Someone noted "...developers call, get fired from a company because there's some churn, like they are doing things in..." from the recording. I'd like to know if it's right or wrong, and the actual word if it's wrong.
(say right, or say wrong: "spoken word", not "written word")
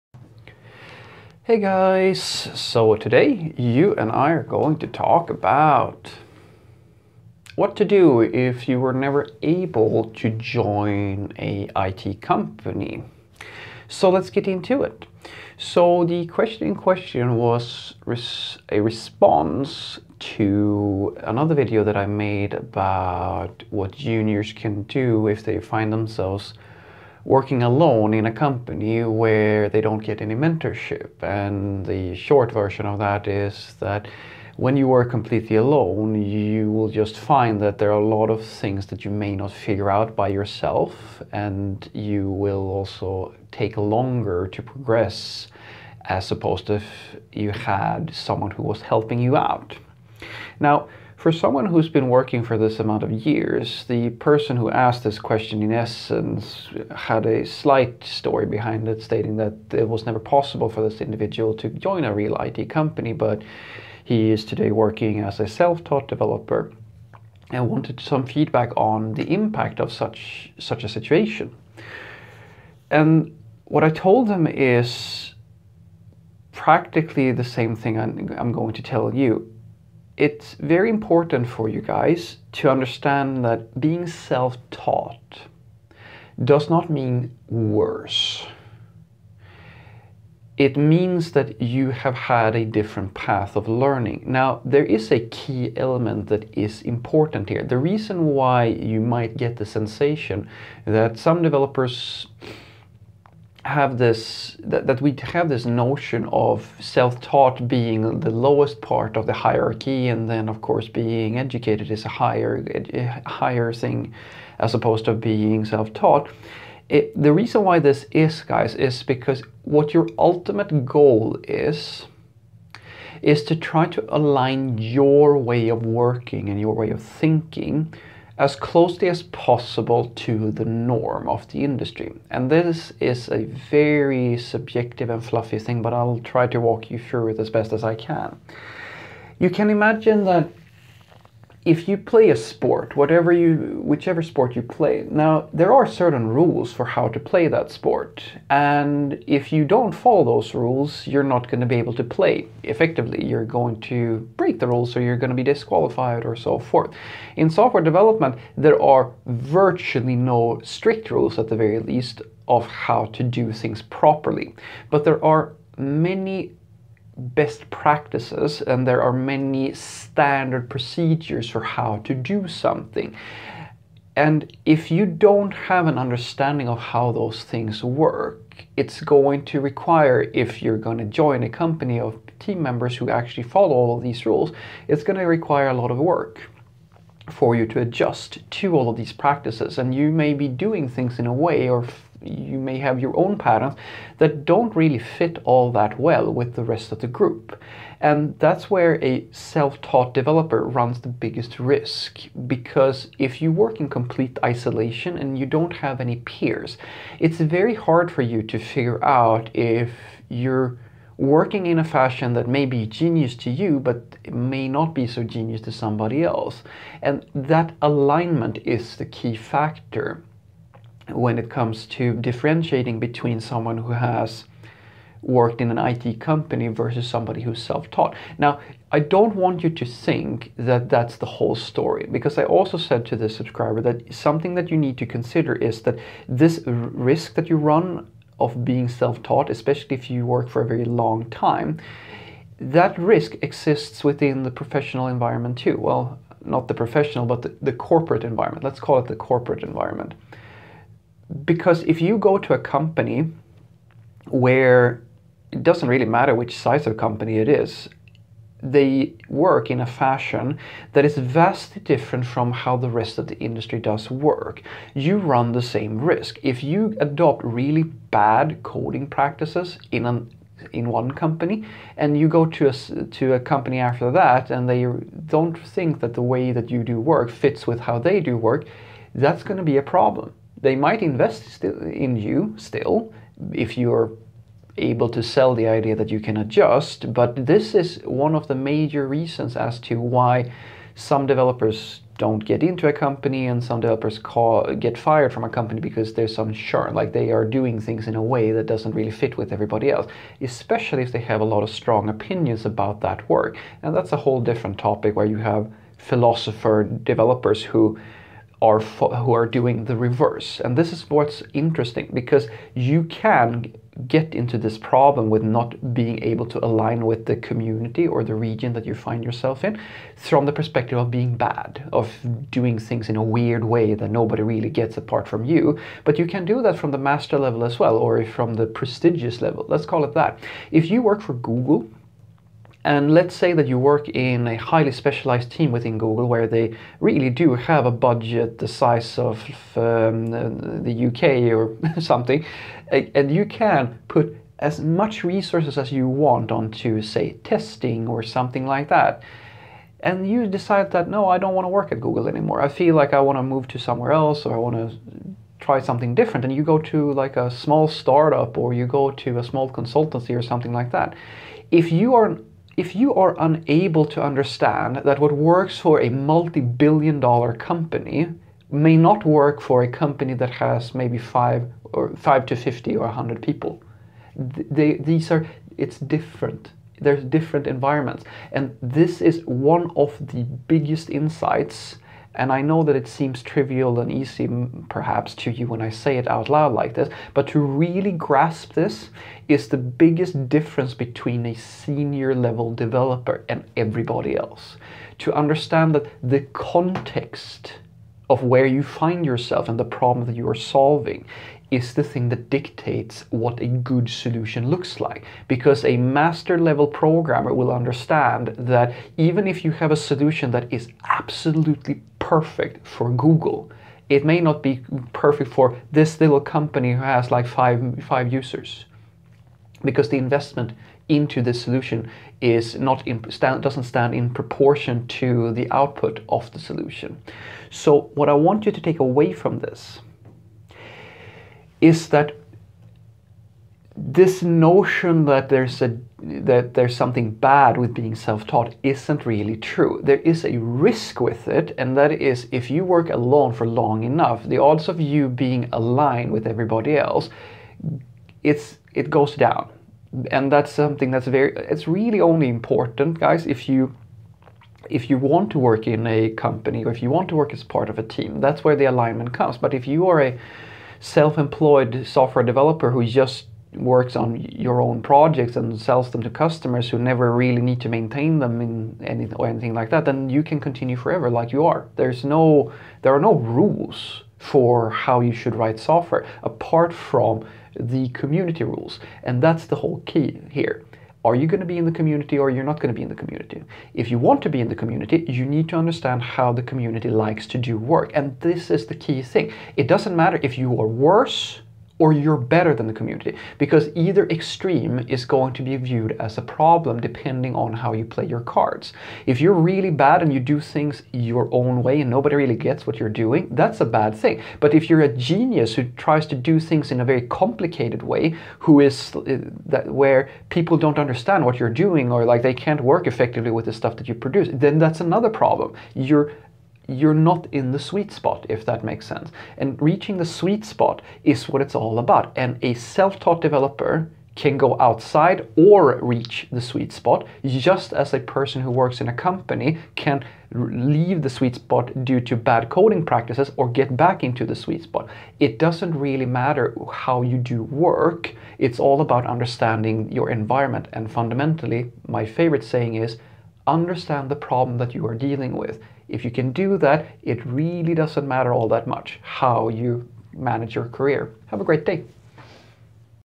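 right.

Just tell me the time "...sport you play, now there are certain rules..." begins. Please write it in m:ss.
2:24.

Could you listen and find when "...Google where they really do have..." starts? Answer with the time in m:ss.
5:35.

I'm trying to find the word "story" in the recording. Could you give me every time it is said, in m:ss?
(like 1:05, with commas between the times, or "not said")
0:58, 3:51.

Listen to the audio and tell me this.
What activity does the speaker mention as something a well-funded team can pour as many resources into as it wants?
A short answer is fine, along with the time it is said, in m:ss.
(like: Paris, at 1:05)
testing, at 5:47.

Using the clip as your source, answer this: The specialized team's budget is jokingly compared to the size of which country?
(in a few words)
the UK.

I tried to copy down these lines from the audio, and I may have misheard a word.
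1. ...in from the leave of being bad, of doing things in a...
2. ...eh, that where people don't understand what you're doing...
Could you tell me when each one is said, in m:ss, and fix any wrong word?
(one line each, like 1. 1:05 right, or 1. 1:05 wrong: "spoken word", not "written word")
1. 5:19 wrong: "perspective", not "leave"
2. 8:29 right.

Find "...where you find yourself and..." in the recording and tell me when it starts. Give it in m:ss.
6:38.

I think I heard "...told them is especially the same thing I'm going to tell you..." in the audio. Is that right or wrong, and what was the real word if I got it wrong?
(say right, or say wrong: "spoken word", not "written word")
wrong: "practically", not "especially".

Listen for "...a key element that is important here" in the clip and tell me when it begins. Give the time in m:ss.
1:35.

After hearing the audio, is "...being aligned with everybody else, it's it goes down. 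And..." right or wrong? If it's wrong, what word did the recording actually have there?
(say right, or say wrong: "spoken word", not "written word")
right.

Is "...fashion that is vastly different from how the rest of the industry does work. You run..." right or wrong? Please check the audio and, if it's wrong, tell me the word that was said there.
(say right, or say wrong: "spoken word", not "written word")
right.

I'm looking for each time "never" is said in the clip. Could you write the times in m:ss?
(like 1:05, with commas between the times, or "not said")
0:08, 1:00, 7:46.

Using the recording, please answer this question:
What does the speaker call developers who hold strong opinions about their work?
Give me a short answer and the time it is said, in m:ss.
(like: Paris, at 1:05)
philosopher developers, at 5:05.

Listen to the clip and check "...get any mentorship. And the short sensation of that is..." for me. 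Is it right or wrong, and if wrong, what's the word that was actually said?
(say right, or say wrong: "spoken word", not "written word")
wrong: "version", not "sensation".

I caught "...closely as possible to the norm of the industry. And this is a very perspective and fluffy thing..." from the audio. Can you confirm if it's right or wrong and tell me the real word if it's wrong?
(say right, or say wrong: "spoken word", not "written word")
wrong: "subjective", not "perspective".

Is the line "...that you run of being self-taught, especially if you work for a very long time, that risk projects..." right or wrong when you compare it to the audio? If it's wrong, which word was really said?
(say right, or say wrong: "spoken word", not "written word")
wrong: "exists", not "projects".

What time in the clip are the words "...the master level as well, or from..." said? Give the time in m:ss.
5:26.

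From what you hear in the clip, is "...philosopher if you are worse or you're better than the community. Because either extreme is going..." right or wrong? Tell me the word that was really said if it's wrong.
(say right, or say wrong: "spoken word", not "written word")
wrong: "matter", not "philosopher".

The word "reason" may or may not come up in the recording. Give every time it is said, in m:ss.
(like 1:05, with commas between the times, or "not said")
1:37, 1:57, 4:49.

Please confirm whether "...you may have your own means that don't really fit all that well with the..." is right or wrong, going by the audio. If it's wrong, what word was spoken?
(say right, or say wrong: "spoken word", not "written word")
wrong: "patterns", not "means".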